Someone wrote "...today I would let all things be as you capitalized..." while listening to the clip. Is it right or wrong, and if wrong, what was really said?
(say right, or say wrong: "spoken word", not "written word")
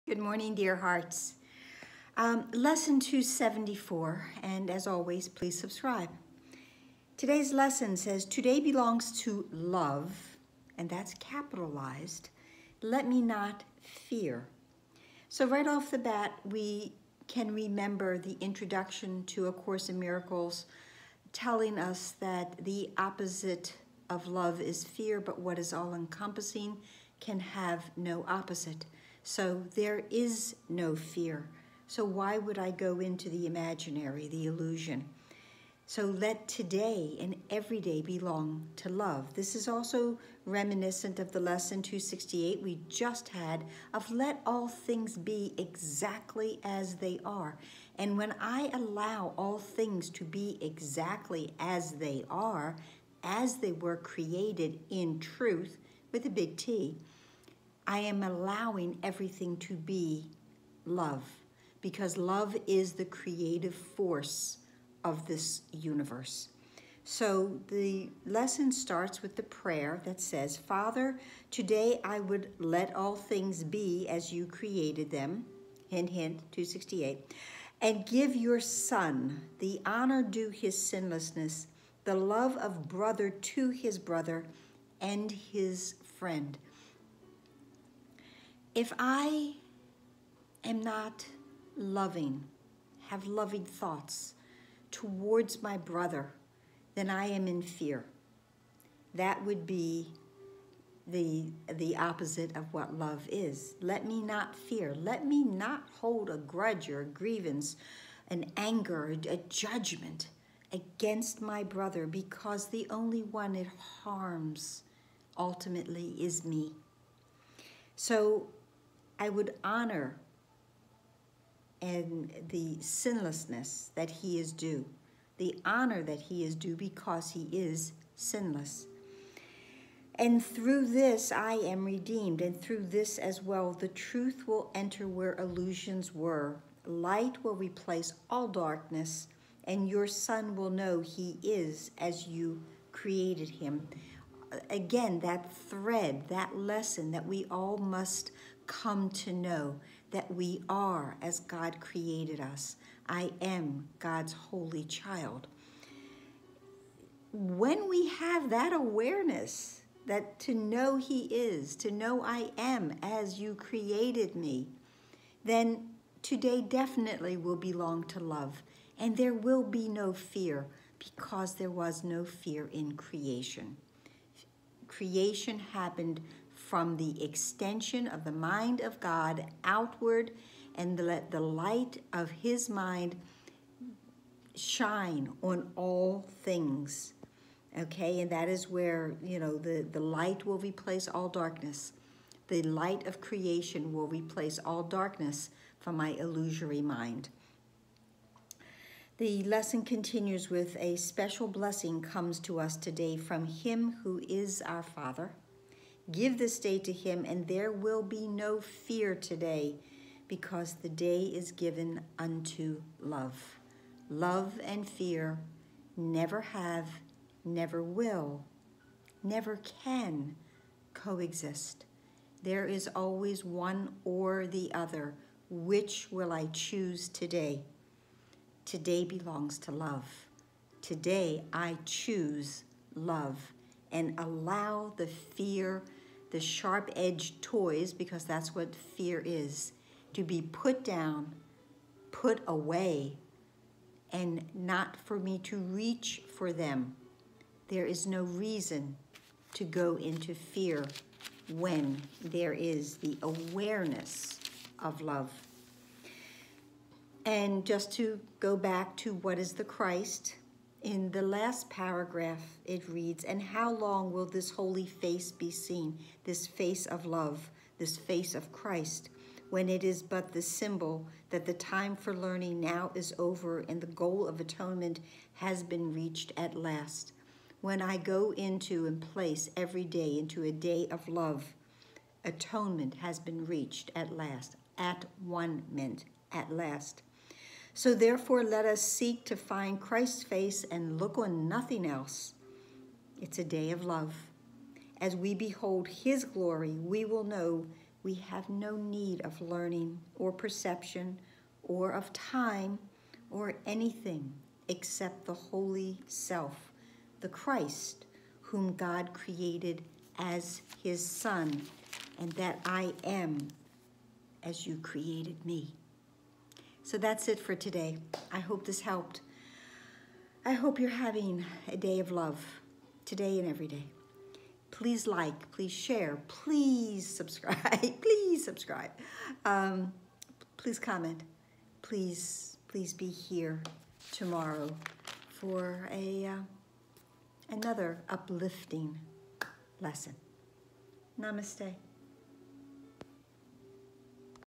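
wrong: "created", not "capitalized".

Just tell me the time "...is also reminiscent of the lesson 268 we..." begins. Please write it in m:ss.
0:39.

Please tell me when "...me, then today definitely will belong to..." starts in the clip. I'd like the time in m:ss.
2:44.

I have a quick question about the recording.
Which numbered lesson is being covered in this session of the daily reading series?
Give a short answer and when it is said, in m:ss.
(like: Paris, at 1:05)
274, at 0:02.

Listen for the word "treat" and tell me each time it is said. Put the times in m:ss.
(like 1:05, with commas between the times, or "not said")
not said.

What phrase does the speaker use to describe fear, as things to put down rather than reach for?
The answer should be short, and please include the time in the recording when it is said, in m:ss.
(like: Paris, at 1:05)
sharp-edged toys, at 3:56.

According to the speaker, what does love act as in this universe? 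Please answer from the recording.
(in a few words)
the creative force.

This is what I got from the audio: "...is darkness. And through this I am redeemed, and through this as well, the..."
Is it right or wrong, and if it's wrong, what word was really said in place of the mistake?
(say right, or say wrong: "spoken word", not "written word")
wrong: "sinless", not "darkness".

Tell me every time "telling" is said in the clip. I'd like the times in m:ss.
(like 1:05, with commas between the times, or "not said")
0:21.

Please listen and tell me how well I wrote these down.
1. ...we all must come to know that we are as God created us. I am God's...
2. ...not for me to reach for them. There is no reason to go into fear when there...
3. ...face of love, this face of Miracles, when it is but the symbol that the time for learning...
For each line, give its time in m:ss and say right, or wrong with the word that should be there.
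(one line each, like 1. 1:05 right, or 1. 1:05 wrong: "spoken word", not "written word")
1. 2:27 right
2. 4:04 right
3. 4:26 wrong: "Christ", not "Miracles".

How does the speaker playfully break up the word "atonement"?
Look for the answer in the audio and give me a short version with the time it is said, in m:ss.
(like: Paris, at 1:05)
at one mint, at 4:44.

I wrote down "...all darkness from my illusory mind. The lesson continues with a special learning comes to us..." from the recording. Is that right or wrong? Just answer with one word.
wrong.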